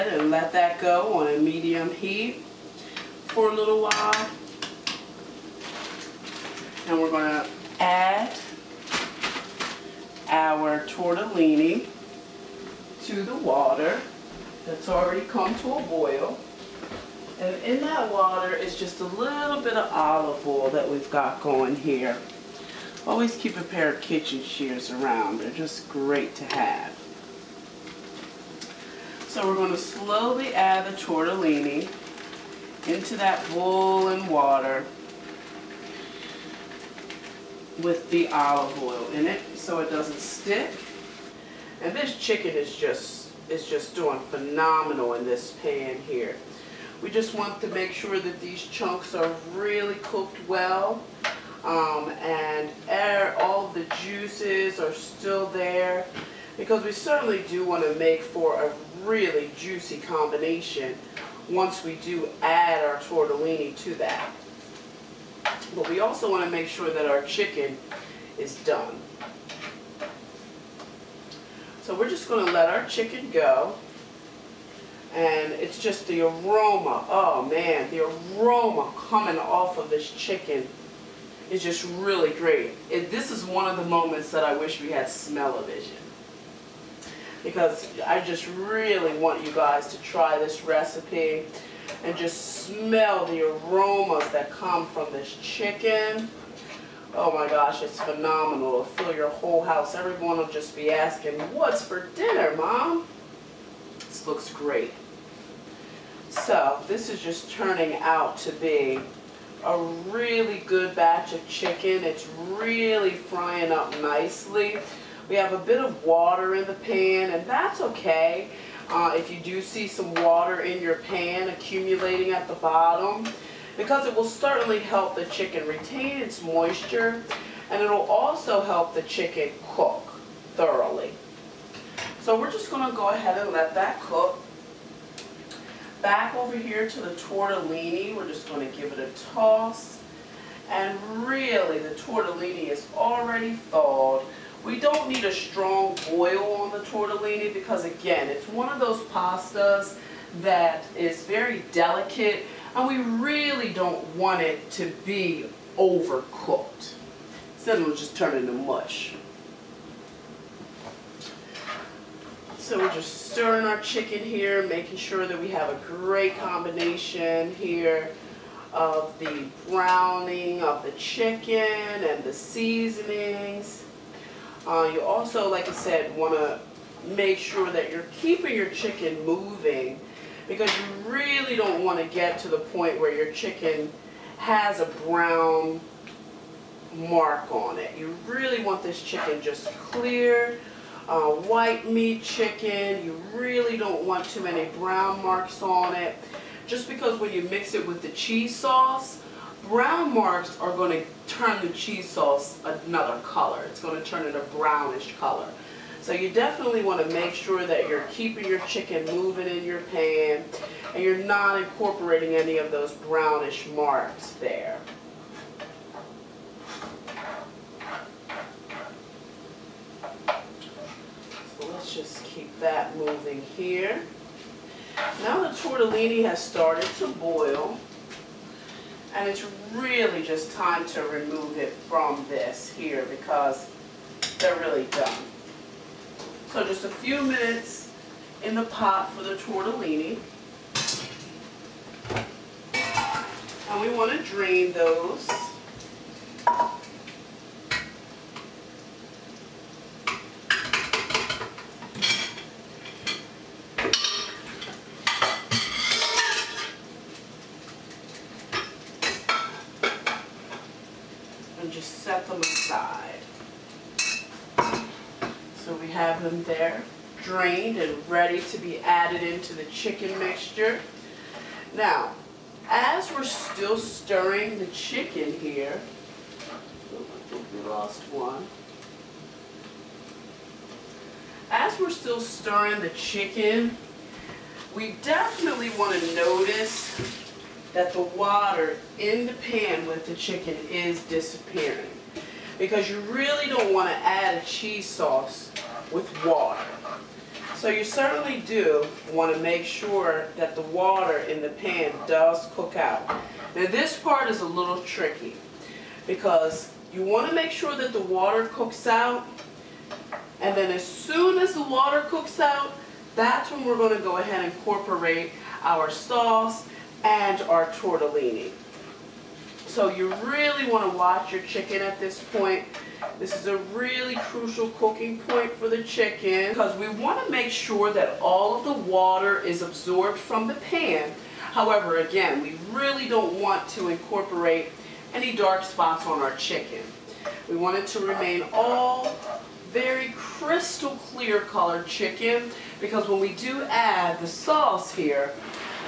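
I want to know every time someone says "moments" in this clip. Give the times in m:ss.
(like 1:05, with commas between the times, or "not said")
1:23.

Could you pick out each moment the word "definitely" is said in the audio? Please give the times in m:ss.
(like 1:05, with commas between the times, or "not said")
3:26, 4:45.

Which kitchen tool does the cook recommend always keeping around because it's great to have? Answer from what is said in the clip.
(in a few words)
kitchen shears.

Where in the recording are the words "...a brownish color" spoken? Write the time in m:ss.
3:24.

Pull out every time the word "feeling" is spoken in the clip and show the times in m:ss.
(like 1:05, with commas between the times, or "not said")
not said.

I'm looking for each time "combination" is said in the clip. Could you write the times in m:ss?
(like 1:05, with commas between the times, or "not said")
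0:59, 2:46.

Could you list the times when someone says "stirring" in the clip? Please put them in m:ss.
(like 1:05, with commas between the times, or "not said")
2:43, 4:33, 4:42.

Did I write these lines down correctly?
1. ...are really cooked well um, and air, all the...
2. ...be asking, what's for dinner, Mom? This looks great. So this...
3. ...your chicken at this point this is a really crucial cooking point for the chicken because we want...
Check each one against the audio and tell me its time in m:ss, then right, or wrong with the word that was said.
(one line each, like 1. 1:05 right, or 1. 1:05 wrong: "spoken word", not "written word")
1. 0:49 right
2. 1:40 right
3. 5:21 right.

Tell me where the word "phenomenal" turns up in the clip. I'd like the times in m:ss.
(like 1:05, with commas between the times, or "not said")
0:44, 1:37.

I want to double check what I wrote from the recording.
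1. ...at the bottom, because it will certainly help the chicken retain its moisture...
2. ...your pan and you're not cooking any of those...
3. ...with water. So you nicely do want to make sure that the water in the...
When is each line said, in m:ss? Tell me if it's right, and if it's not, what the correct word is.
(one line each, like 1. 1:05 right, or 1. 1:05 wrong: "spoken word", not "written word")
1. 2:02 right
2. 3:29 wrong: "incorporating", not "cooking"
3. 4:55 wrong: "certainly", not "nicely".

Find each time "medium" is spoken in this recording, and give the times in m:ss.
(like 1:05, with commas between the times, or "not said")
0:01.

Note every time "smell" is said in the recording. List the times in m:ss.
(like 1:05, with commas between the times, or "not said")
1:25, 1:32.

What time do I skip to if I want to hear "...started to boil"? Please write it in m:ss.
3:46.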